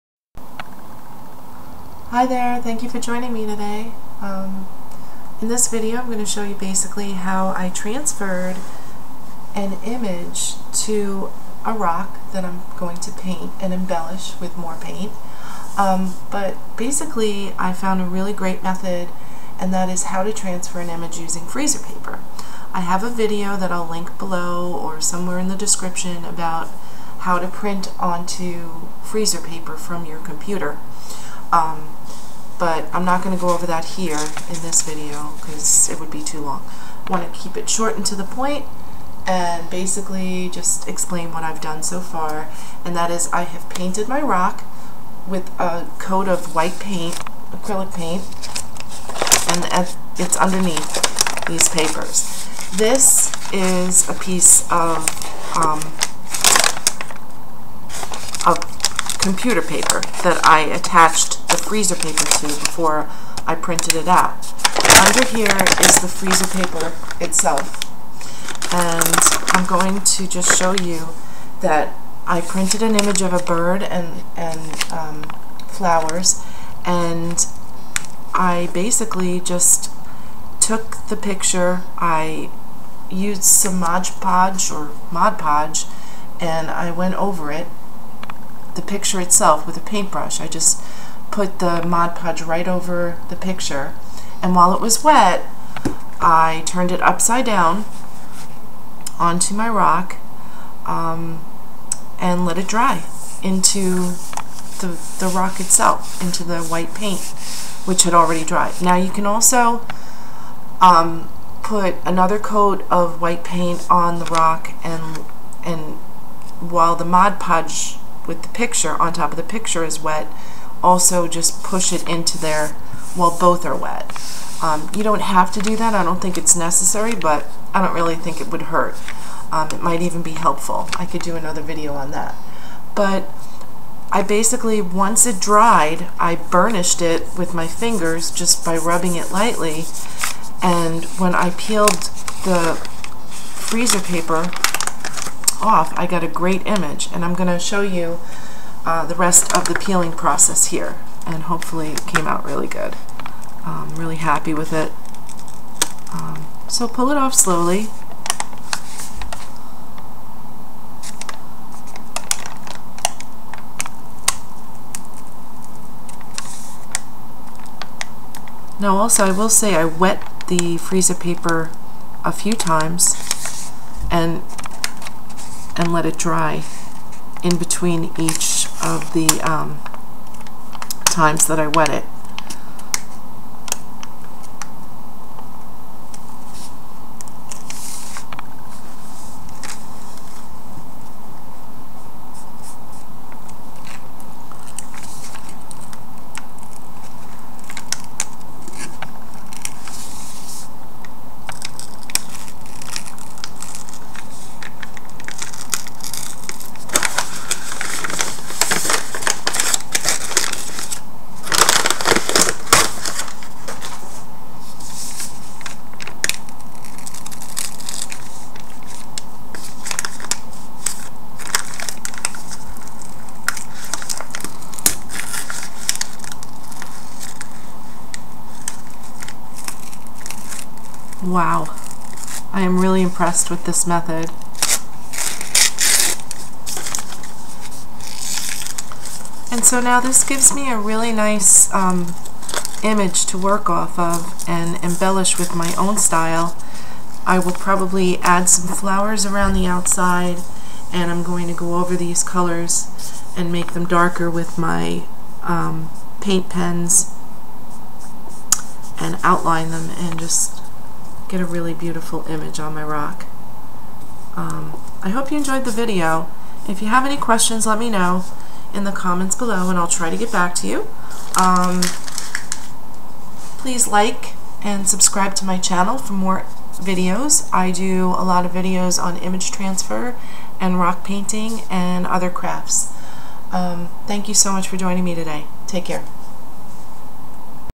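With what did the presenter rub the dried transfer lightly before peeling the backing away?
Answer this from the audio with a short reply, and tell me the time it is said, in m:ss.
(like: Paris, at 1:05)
Fingers, at 2:17.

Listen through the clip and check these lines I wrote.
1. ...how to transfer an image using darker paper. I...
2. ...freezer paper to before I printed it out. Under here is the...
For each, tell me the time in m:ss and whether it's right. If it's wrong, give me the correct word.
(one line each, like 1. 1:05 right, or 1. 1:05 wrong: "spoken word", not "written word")
1. 0:20 wrong: "freezer", not "darker"
2. 1:01 right.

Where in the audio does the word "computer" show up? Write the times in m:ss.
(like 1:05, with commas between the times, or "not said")
0:30, 0:59.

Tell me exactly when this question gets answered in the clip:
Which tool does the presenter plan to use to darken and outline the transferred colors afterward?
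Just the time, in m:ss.
4:16.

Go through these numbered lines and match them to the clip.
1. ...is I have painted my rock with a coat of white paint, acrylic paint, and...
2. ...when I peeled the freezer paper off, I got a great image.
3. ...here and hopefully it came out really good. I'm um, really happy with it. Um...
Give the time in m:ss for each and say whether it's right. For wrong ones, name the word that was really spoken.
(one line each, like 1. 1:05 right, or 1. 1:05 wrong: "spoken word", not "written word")
1. 0:43 right
2. 2:21 right
3. 2:30 right.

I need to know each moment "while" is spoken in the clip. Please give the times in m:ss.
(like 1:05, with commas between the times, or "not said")
1:34, 1:56, 2:03.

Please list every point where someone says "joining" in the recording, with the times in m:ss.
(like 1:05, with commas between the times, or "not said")
0:02, 4:44.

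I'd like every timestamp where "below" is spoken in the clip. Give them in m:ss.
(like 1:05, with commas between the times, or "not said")
0:24, 4:29.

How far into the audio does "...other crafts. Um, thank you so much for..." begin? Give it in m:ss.
4:42.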